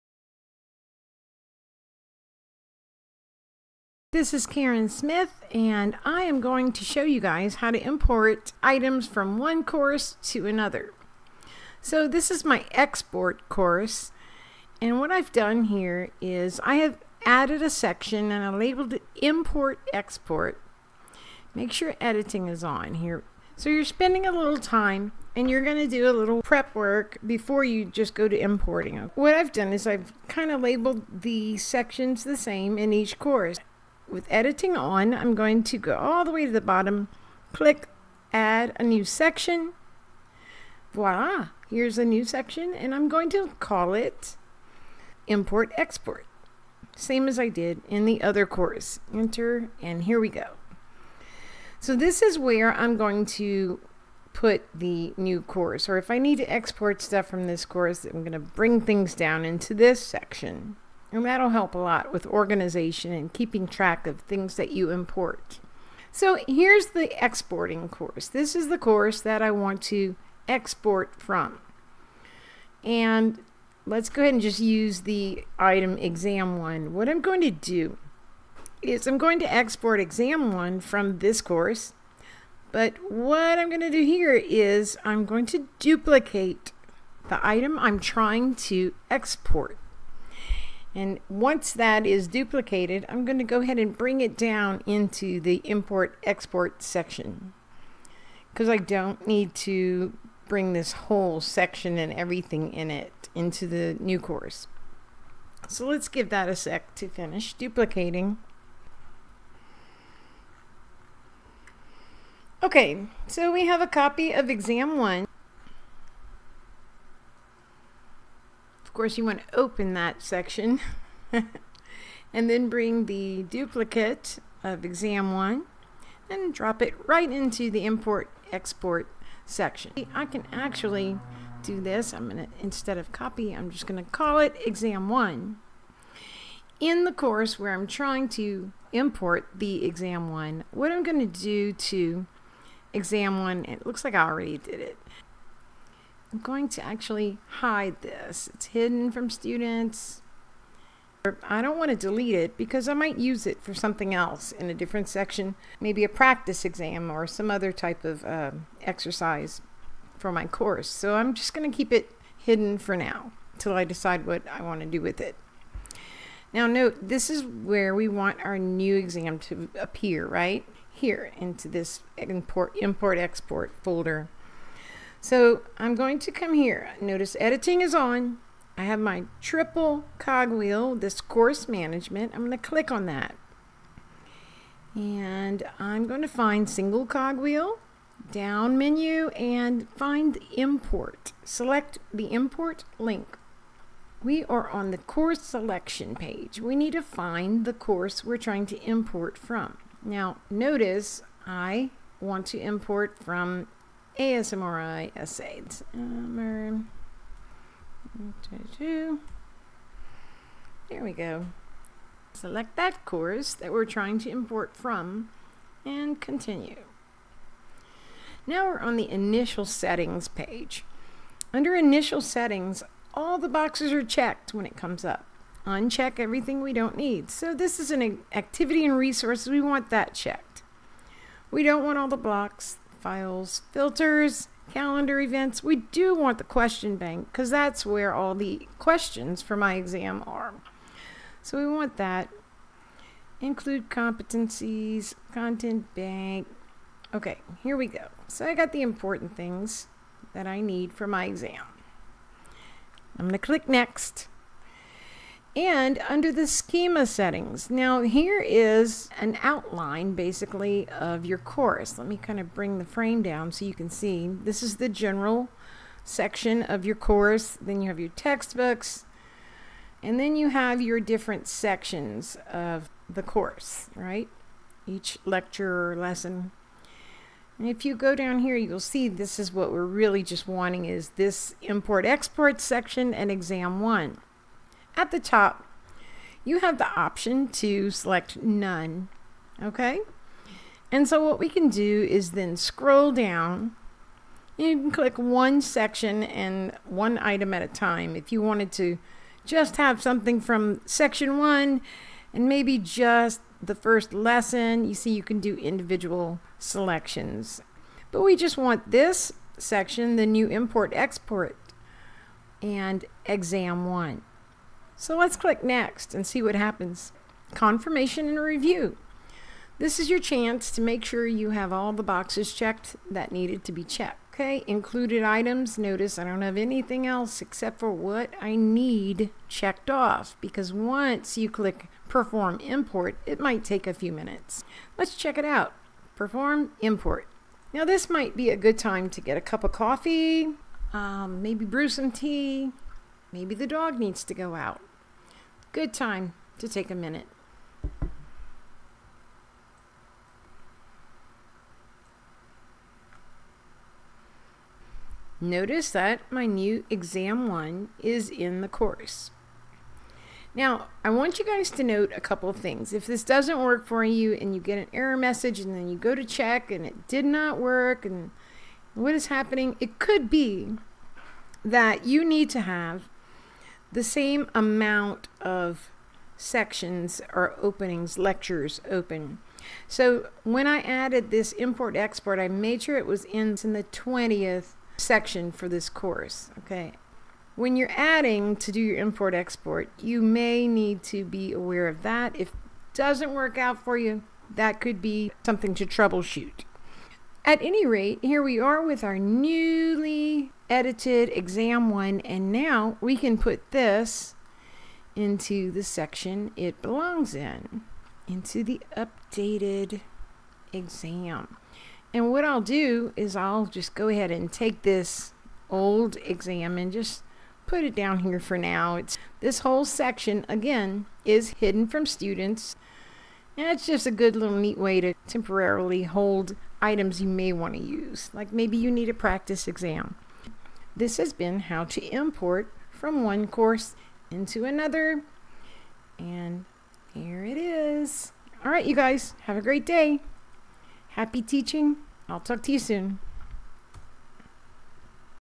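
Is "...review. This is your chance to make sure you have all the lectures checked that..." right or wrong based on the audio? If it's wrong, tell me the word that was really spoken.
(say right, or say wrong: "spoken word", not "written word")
wrong: "boxes", not "lectures".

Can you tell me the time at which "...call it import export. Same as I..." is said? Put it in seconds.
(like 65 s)
43 s.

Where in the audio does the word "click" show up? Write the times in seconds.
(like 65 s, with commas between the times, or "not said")
37 s, 182 s, 253 s, 294 s, 315 s, 331 s.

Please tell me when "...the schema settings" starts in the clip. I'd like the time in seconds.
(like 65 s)
256 s.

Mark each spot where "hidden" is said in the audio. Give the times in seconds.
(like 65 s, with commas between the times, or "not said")
148 s, 162 s, 421 s.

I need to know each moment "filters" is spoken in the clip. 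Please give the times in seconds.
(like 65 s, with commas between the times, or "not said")
233 s.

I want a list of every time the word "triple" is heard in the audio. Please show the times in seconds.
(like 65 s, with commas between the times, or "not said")
179 s.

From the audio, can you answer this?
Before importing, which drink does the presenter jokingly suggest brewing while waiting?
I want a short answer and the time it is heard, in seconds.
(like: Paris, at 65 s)
tea, at 342 s.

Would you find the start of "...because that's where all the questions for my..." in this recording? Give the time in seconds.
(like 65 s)
237 s.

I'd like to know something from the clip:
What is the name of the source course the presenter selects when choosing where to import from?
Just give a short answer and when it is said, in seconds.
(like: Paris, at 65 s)
ASMRI essays, at 204 s.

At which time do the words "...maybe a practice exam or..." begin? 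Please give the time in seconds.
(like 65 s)
155 s.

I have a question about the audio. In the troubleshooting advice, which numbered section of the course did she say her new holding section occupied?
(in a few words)
20th.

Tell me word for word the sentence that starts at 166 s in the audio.
Now note, this is where we want our new exam to appear, right?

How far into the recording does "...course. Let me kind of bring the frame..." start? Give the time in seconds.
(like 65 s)
261 s.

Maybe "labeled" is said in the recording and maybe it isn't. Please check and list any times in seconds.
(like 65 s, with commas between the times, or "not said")
18 s, 30 s.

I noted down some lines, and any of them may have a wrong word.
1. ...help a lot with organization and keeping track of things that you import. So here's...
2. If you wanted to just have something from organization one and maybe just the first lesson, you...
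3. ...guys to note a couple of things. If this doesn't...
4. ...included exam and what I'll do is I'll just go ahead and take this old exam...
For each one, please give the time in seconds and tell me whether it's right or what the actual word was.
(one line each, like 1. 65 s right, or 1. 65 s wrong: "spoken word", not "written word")
1. 61 s right
2. 298 s wrong: "section", not "organization"
3. 361 s right
4. 408 s wrong: "updated", not "included".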